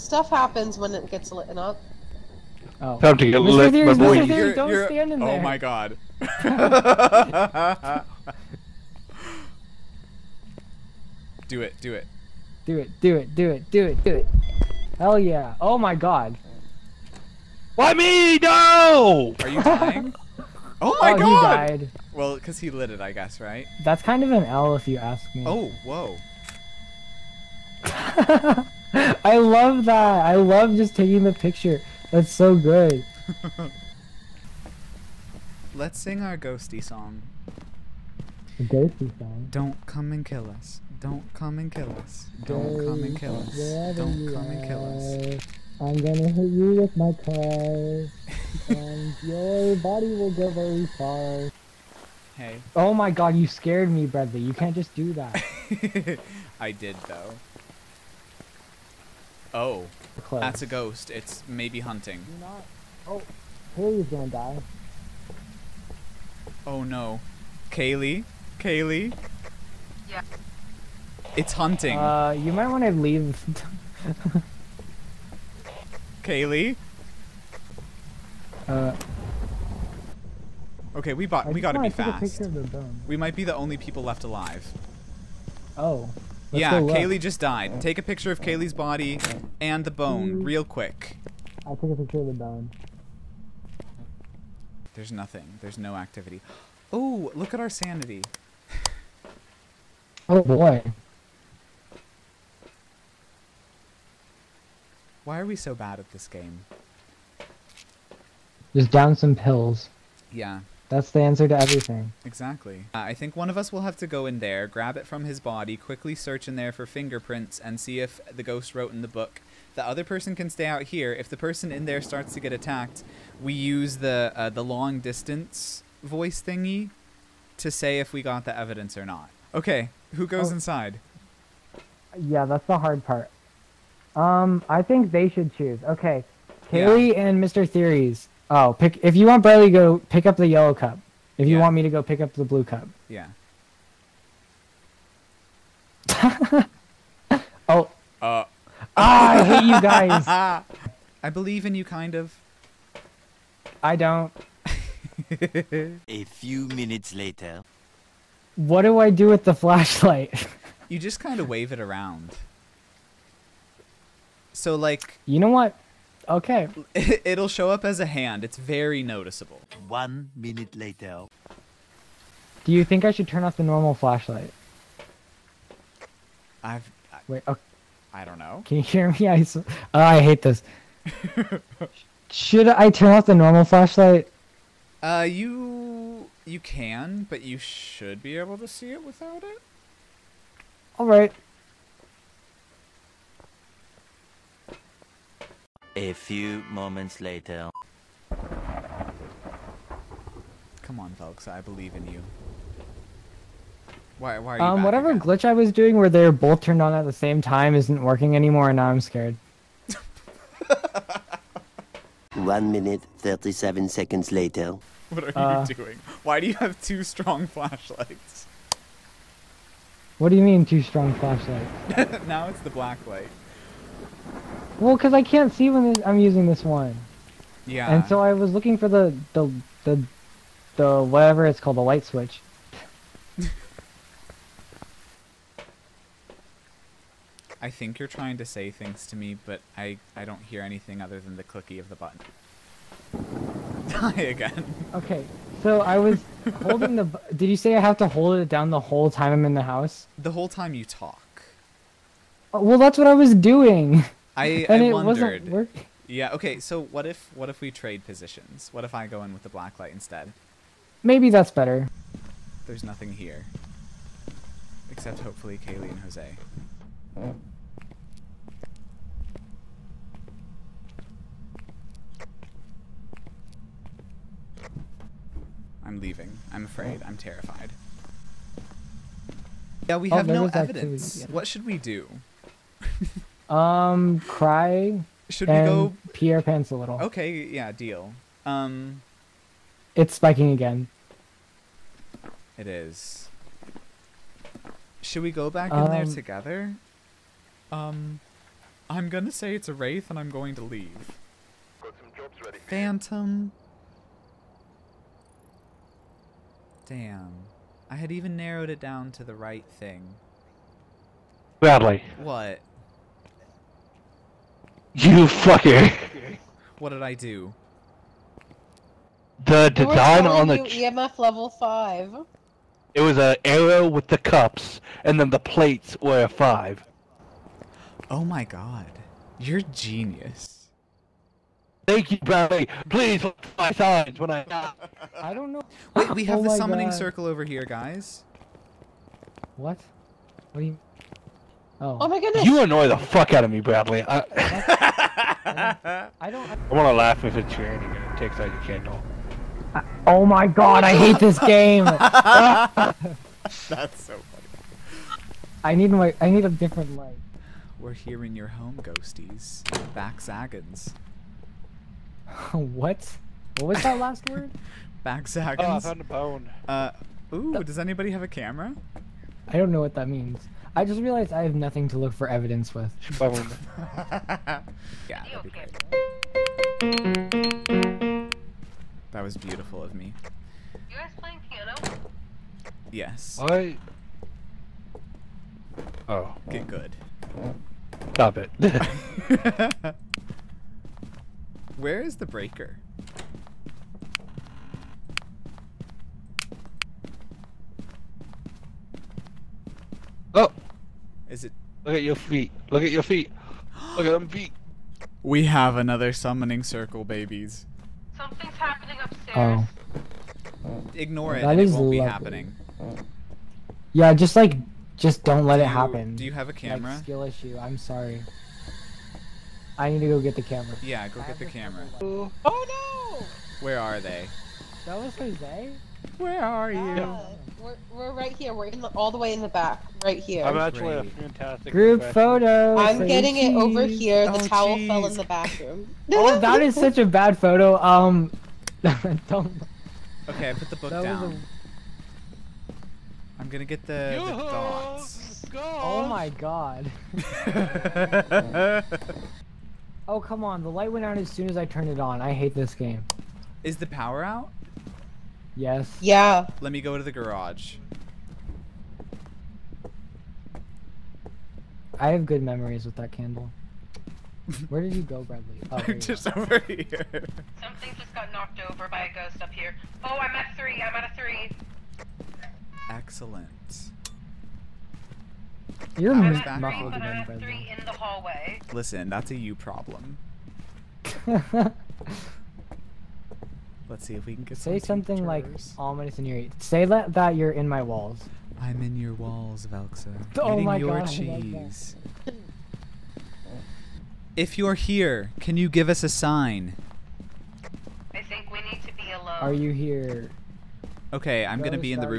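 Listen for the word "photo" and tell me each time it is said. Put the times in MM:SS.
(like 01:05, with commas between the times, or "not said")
07:12, 07:17.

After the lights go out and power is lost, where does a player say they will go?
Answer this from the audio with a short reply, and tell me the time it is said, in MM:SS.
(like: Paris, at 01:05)
The garage, at 07:37.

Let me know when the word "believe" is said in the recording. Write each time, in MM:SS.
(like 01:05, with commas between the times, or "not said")
02:31, 03:21.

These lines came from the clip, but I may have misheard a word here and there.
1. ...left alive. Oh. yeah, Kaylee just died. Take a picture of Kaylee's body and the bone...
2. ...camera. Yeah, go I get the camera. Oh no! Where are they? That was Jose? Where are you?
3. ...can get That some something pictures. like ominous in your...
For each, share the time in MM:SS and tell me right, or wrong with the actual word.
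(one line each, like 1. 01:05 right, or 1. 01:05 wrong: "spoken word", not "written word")
1. 01:24 right
2. 07:00 right
3. 08:04 wrong: "Say", not "That".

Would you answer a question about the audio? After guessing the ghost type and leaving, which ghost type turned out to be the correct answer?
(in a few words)
Phantom.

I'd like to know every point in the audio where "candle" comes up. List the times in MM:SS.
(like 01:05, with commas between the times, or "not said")
05:48, 07:43.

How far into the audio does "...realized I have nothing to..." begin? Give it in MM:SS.
06:11.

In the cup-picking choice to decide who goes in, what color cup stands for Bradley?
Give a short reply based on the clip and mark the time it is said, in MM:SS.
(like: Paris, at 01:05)
Yellow, at 02:20.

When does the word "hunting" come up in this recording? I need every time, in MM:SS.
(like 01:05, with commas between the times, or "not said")
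01:01, 01:11.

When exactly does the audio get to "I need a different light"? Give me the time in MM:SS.
05:56.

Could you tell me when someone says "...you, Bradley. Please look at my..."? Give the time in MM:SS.
05:32.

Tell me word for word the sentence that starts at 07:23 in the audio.
i am gonna get the, the dots.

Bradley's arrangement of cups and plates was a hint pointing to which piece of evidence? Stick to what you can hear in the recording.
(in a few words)
EMF level 5.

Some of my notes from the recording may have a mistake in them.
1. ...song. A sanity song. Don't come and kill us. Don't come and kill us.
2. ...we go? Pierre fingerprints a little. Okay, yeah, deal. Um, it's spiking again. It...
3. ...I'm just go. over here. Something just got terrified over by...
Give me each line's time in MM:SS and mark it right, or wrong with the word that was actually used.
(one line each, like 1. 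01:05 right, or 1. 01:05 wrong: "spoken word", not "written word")
1. 00:36 wrong: "ghosty", not "sanity"
2. 04:45 wrong: "pants", not "fingerprints"
3. 07:45 wrong: "knocked", not "terrified".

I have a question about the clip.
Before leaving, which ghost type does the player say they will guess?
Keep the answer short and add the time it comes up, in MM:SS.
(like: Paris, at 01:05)
Wraith, at 04:59.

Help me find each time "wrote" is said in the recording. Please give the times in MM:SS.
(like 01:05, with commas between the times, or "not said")
01:58.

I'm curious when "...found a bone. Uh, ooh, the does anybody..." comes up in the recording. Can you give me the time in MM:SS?
06:05.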